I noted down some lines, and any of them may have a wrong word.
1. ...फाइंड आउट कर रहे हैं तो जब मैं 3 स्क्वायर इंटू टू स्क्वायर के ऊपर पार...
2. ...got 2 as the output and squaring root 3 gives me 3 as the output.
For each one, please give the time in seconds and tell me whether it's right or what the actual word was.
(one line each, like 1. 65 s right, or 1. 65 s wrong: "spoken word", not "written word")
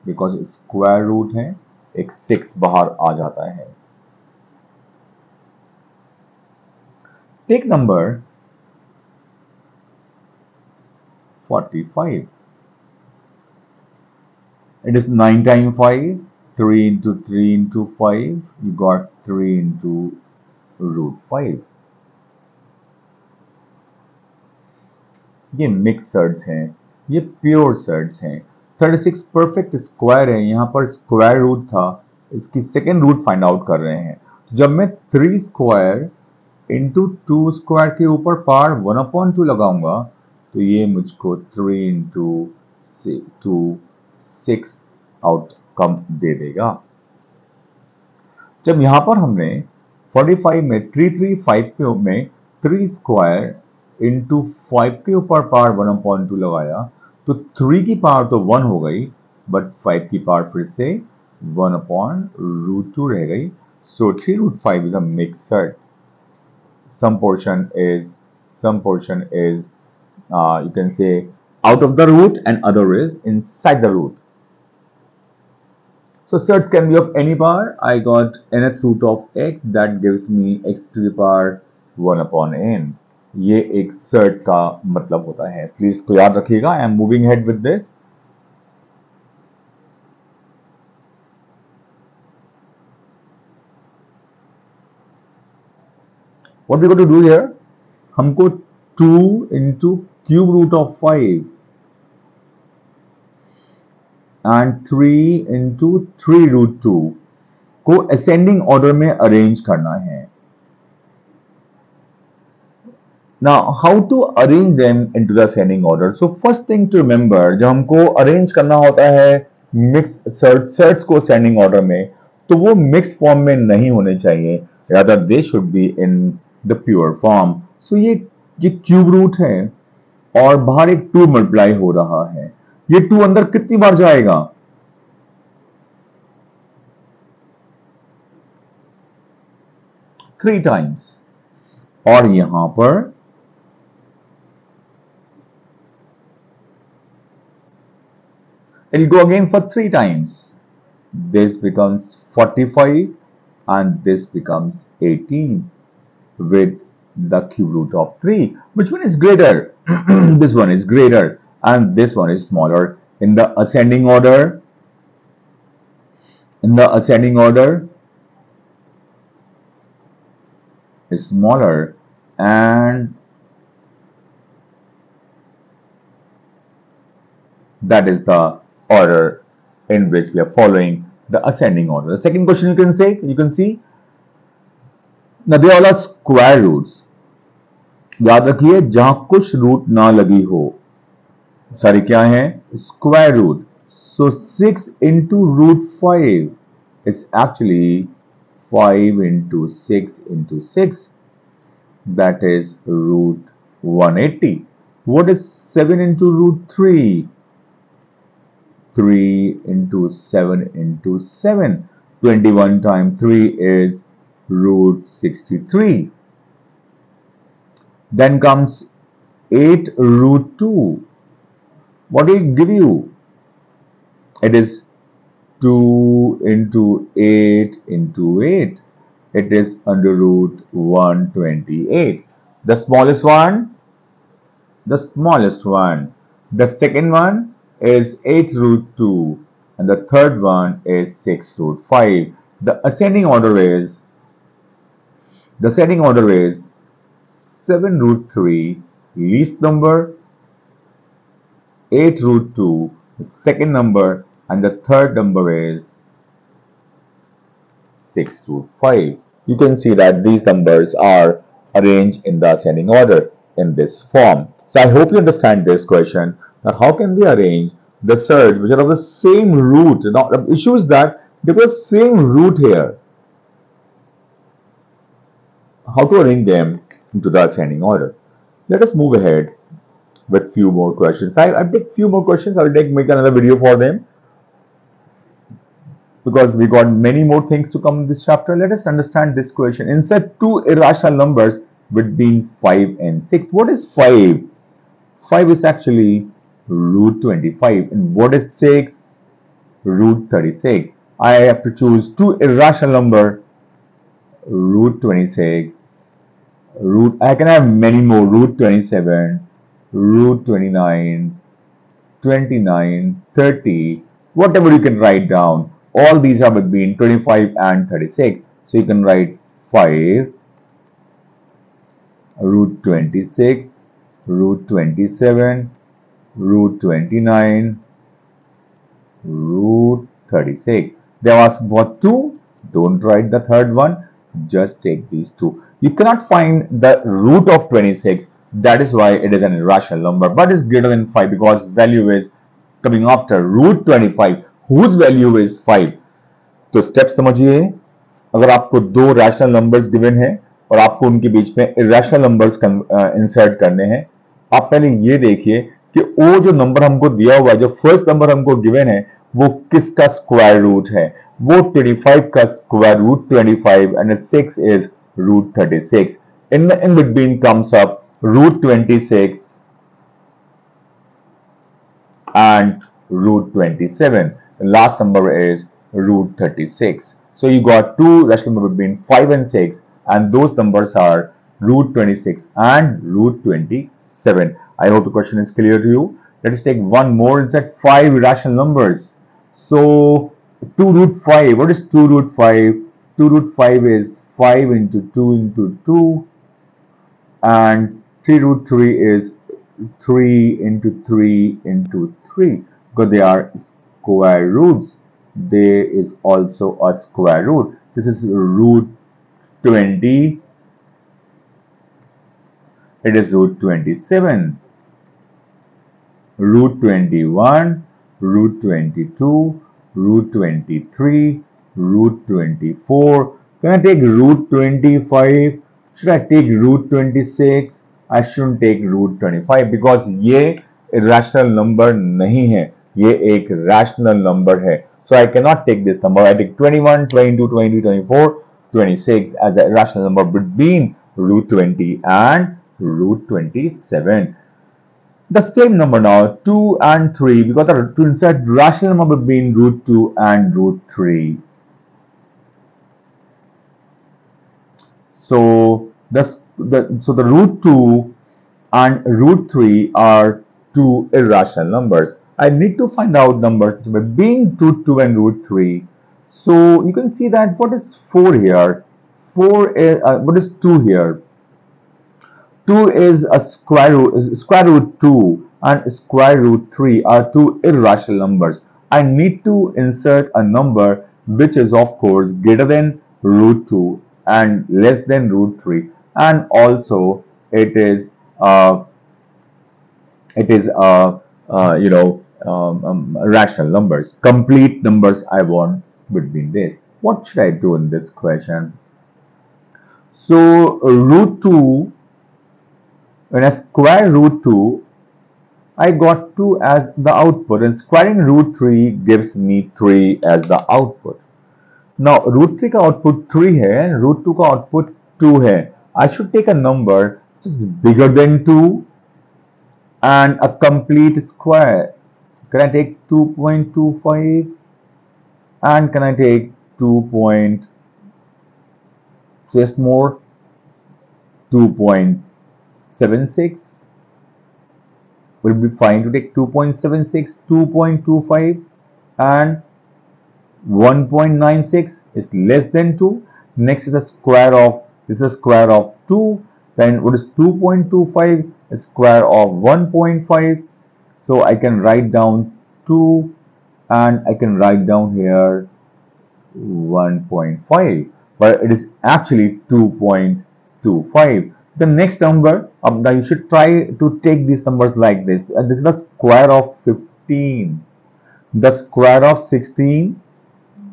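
1. 33 s right
2. 505 s right.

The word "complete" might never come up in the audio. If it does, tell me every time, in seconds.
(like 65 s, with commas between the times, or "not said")
494 s, 520 s.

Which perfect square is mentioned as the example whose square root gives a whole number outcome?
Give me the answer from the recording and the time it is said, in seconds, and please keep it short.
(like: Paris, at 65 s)
36, at 28 s.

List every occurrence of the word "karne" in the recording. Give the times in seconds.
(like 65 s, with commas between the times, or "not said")
353 s.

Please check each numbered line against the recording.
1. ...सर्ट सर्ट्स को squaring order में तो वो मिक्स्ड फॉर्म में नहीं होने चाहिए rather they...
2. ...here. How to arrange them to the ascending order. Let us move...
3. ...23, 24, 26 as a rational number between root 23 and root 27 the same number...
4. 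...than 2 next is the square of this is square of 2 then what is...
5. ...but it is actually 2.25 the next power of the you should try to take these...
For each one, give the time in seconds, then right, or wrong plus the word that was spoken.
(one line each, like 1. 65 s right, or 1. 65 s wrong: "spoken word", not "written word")
1. 120 s wrong: "ascending", not "squaring"
2. 272 s right
3. 437 s wrong: "20", not "23"
4. 542 s right
5. 558 s wrong: "number", not "power".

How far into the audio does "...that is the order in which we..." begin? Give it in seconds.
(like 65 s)
177 s.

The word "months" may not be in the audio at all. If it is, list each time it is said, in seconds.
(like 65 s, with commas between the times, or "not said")
not said.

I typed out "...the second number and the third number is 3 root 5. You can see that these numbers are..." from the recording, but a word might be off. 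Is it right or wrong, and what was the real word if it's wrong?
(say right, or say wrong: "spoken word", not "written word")
wrong: "6", not "3".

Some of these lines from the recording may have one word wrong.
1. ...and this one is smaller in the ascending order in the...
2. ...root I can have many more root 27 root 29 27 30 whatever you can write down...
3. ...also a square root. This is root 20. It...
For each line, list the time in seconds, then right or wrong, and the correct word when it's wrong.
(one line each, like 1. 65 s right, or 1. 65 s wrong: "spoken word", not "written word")
1. 161 s right
2. 306 s wrong: "29", not "27"
3. 406 s right.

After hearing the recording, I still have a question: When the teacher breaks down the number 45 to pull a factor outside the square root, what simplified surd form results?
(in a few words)
3 root 5.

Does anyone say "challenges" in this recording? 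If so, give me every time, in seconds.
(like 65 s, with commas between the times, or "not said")
not said.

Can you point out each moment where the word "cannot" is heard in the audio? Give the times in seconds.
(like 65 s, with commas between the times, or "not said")
335 s, 435 s.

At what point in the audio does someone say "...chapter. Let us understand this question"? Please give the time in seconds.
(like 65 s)
288 s.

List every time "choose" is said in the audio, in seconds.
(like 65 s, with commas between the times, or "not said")
301 s.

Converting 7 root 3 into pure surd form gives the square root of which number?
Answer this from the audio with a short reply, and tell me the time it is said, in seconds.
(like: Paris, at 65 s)
63, at 214 s.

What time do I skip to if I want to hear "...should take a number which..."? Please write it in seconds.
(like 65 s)
516 s.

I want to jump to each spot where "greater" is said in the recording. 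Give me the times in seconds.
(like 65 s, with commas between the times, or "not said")
160 s, 340 s, 482 s.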